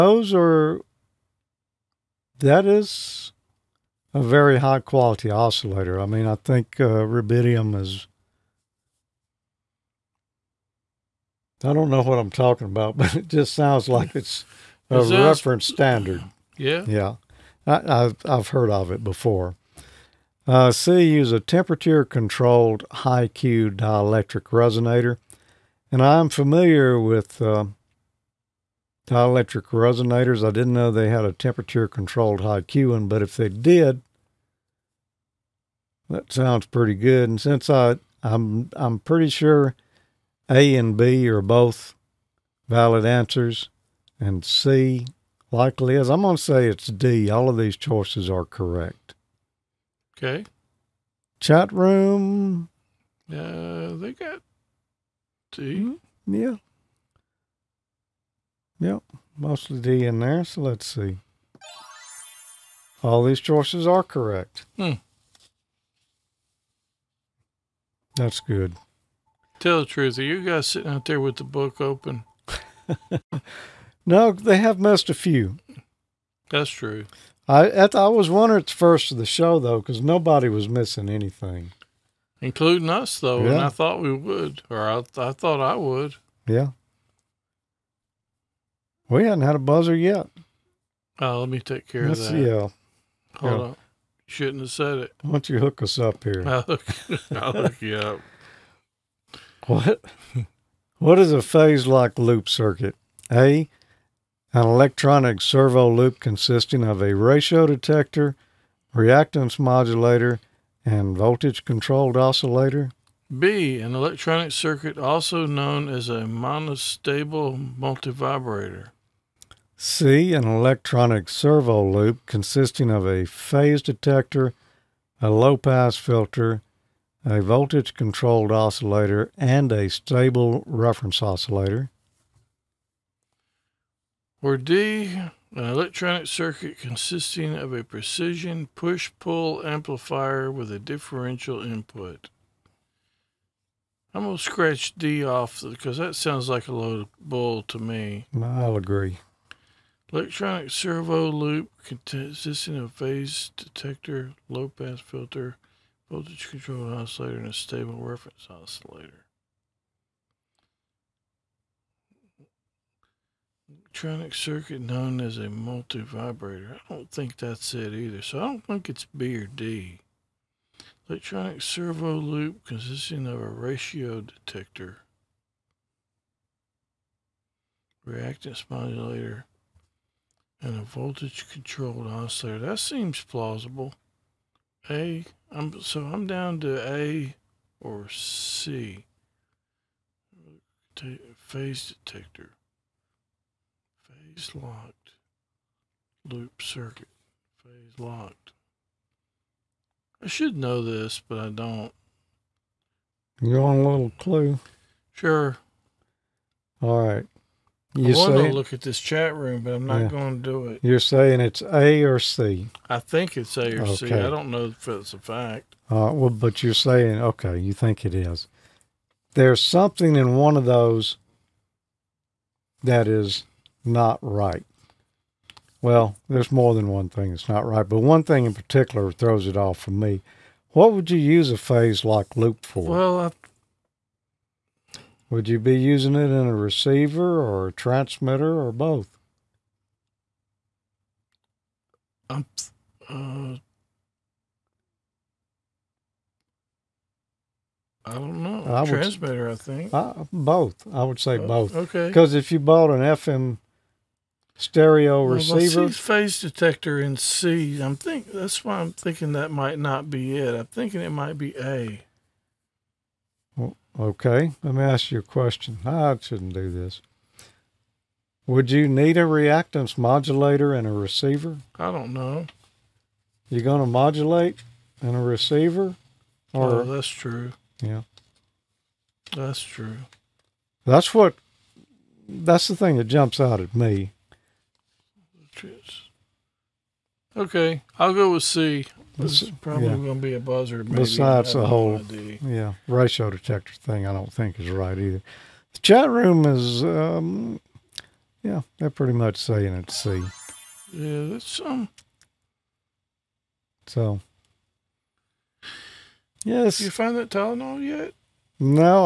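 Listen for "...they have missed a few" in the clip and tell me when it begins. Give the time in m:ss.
1:14.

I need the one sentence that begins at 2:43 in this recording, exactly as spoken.
electronic circuit known as a multivibrator.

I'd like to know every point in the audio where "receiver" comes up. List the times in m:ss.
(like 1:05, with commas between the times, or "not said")
3:56, 4:15, 4:30, 4:35.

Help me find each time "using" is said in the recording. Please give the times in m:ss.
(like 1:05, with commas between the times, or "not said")
3:55.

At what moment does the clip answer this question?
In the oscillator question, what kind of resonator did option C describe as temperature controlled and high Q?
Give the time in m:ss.
0:23.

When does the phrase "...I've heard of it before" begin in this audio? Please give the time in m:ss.
0:18.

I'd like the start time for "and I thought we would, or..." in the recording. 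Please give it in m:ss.
1:23.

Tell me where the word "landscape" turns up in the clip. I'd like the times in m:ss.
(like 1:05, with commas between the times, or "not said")
not said.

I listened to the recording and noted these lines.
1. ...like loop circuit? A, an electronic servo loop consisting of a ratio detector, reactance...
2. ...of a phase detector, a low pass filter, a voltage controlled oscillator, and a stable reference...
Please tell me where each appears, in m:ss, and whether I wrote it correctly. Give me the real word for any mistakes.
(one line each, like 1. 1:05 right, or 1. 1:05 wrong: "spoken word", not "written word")
1. 1:41 right
2. 2:02 right.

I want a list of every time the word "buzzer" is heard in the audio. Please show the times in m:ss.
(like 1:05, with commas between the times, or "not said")
1:29, 4:50.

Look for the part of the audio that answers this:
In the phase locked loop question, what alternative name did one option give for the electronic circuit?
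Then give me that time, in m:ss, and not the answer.
1:56.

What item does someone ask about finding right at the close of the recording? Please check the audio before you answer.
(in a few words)
Tylenol.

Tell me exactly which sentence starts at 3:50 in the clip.
What would you use a phase lock loop for?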